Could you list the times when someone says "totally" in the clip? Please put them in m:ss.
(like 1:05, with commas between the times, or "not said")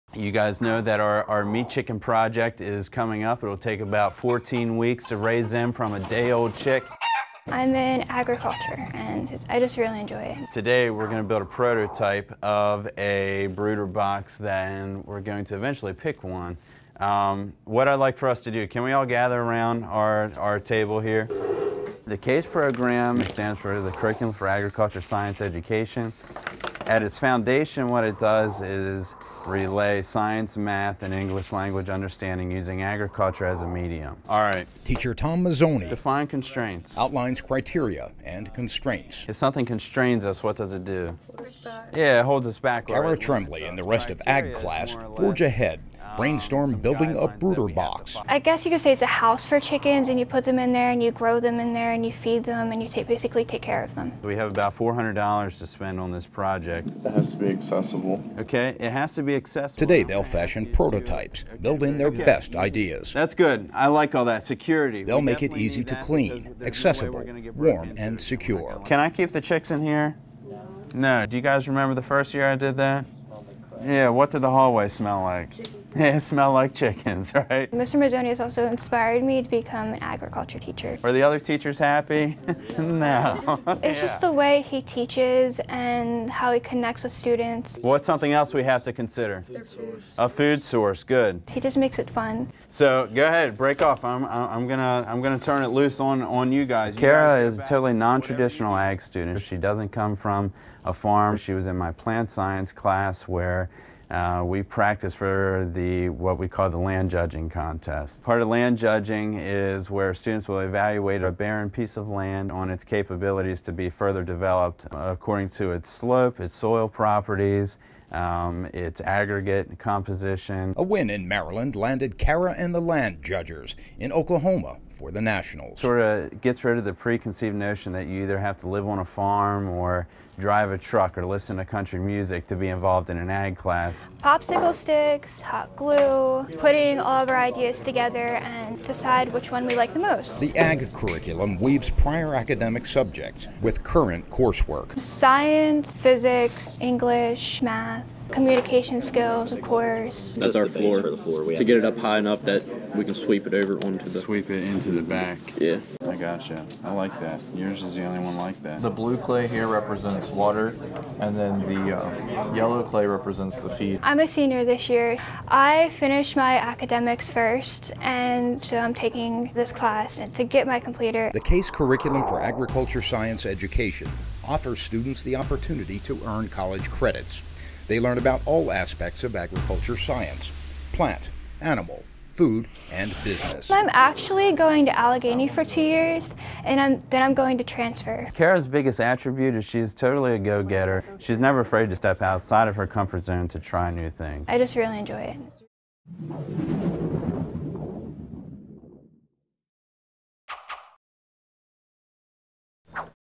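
1:37, 3:09.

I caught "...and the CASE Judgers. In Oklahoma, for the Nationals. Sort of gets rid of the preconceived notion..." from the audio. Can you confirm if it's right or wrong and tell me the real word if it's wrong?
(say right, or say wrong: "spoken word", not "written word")
wrong: "Land", not "CASE".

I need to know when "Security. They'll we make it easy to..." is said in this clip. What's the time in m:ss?
1:04.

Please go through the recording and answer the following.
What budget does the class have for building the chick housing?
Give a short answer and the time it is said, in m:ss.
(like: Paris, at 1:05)
$400, at 0:54.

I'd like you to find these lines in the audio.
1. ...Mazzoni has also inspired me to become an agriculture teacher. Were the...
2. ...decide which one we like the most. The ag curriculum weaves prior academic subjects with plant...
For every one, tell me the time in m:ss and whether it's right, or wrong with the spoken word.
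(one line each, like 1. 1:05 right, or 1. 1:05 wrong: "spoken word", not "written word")
1. 1:17 right
2. 2:18 wrong: "current", not "plant".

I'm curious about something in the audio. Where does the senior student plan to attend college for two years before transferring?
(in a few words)
Allegany.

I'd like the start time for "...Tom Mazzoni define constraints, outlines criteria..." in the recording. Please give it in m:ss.
0:35.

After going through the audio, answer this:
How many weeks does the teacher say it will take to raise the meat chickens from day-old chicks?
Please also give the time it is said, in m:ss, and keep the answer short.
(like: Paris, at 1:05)
14, at 0:04.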